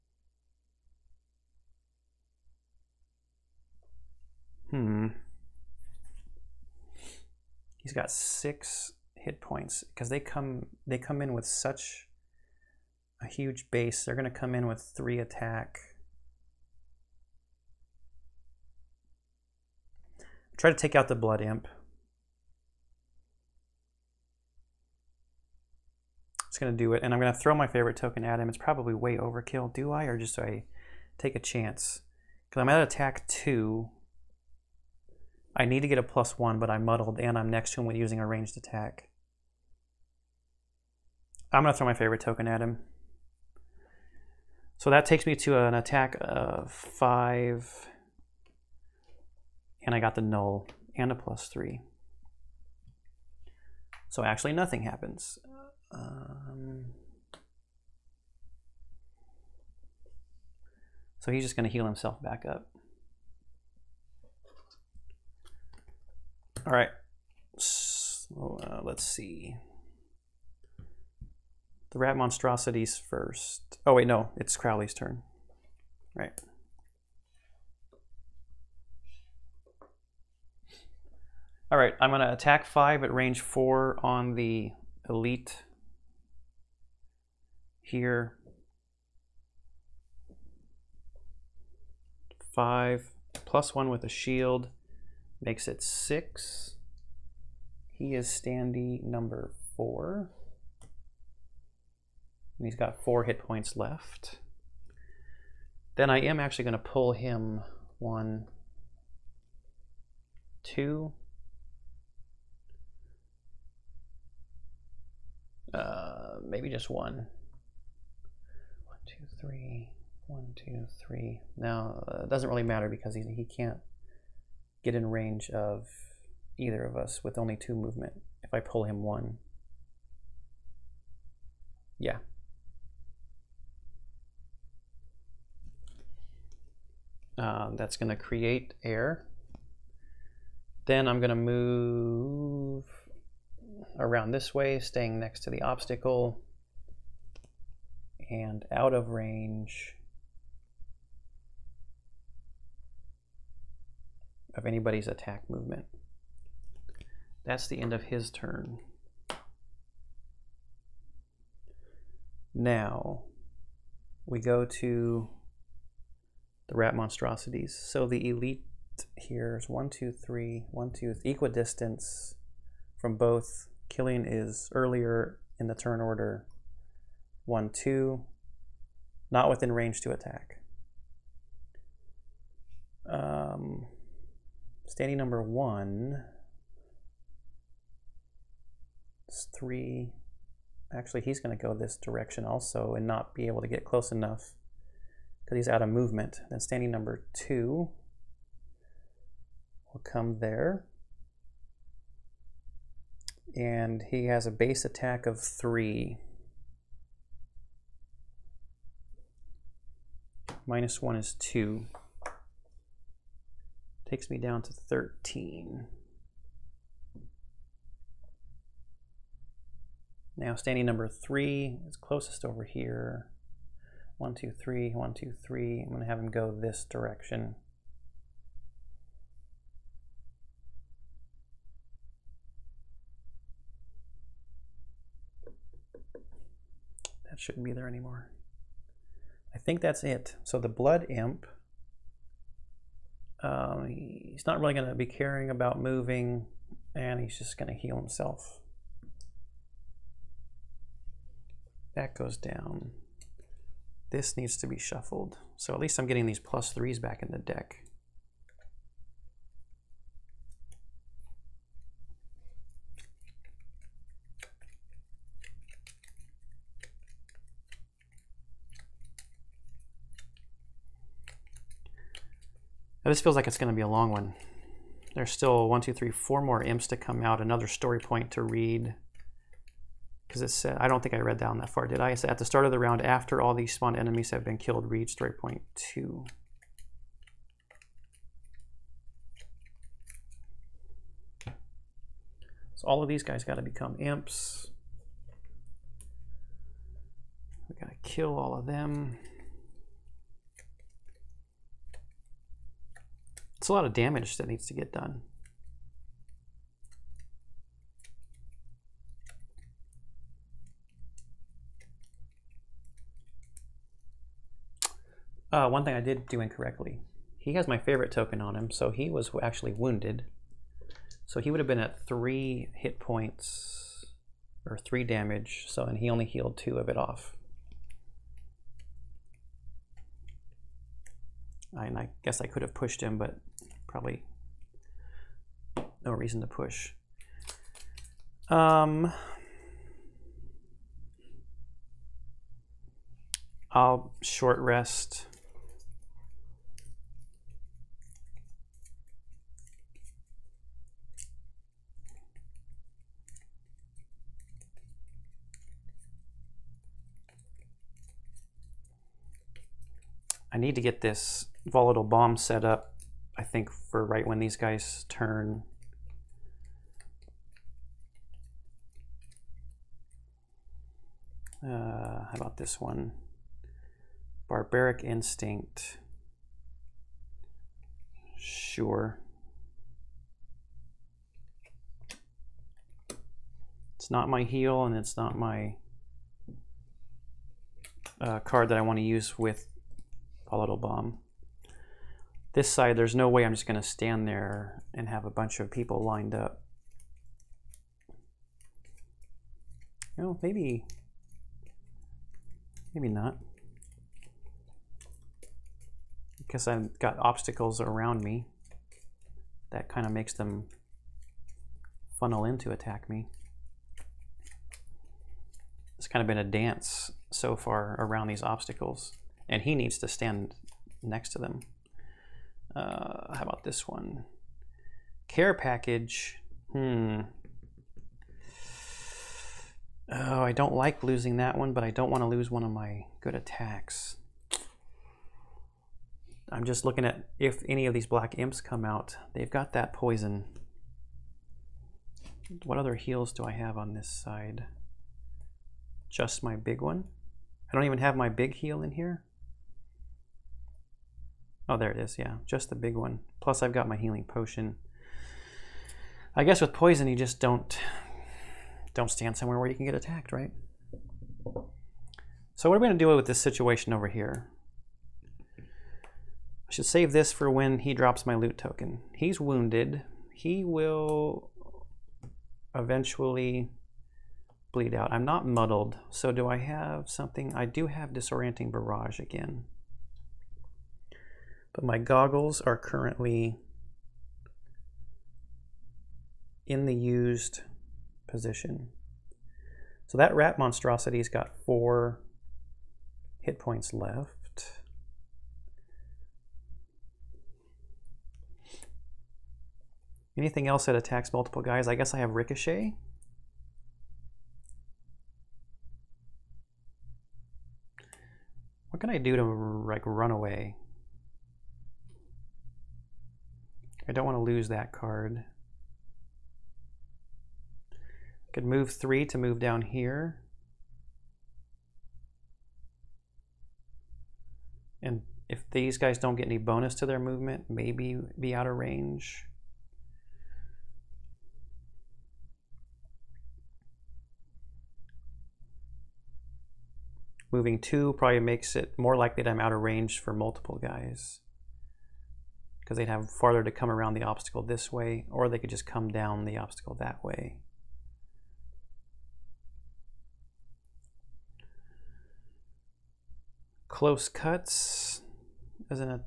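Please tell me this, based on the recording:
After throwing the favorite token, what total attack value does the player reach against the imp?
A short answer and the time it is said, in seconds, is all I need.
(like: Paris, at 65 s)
5, at 45 s.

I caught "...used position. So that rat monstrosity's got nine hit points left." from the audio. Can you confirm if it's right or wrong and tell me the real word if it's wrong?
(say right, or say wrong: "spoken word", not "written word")
wrong: "four", not "nine".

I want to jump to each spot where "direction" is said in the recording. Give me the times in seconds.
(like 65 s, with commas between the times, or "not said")
192 s, 226 s.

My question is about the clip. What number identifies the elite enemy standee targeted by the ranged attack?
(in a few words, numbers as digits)
4.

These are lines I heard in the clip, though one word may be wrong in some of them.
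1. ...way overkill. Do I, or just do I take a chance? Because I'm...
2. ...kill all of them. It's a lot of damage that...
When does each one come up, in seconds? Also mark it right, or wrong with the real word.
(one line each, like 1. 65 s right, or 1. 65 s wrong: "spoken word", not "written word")
1. 28 s right
2. 298 s right.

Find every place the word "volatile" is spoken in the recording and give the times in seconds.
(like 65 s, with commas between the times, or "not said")
361 s, 390 s.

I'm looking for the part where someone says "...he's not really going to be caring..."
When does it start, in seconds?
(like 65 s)
243 s.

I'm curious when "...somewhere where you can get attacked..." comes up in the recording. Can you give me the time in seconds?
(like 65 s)
459 s.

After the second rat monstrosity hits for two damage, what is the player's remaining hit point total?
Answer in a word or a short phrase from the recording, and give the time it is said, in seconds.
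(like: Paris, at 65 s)
13, at 214 s.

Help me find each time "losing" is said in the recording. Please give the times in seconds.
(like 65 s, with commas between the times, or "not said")
431 s.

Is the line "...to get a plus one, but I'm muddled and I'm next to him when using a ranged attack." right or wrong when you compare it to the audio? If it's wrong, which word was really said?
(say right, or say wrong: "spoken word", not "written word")
right.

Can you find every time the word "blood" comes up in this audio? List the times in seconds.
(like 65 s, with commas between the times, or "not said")
21 s, 240 s.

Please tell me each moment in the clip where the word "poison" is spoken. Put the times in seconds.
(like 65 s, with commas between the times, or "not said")
439 s, 456 s.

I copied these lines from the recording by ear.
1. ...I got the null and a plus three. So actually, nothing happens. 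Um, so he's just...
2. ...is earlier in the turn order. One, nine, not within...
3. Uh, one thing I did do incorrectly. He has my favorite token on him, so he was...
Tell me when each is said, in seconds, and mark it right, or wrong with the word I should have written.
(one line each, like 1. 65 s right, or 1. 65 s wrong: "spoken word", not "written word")
1. 49 s right
2. 174 s wrong: "two", not "nine"
3. 315 s right.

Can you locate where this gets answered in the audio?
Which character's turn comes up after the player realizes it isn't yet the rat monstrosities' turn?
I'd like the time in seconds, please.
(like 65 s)
74 s.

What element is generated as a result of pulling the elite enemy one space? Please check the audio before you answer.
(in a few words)
Air.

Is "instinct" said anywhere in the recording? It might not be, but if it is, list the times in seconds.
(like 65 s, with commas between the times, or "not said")
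375 s.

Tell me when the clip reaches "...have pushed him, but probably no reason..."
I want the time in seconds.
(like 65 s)
332 s.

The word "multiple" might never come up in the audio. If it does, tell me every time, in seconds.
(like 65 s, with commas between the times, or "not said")
501 s, 540 s.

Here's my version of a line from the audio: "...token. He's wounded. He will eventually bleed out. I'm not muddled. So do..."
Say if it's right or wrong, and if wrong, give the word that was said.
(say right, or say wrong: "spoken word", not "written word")
right.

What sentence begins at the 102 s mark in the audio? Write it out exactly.
And he's got four hit points left.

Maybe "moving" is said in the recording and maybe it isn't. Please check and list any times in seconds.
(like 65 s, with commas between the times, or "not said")
245 s, 537 s.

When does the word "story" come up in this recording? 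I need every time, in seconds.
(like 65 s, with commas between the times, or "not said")
277 s, 285 s.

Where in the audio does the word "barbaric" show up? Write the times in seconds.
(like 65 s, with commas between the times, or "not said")
374 s.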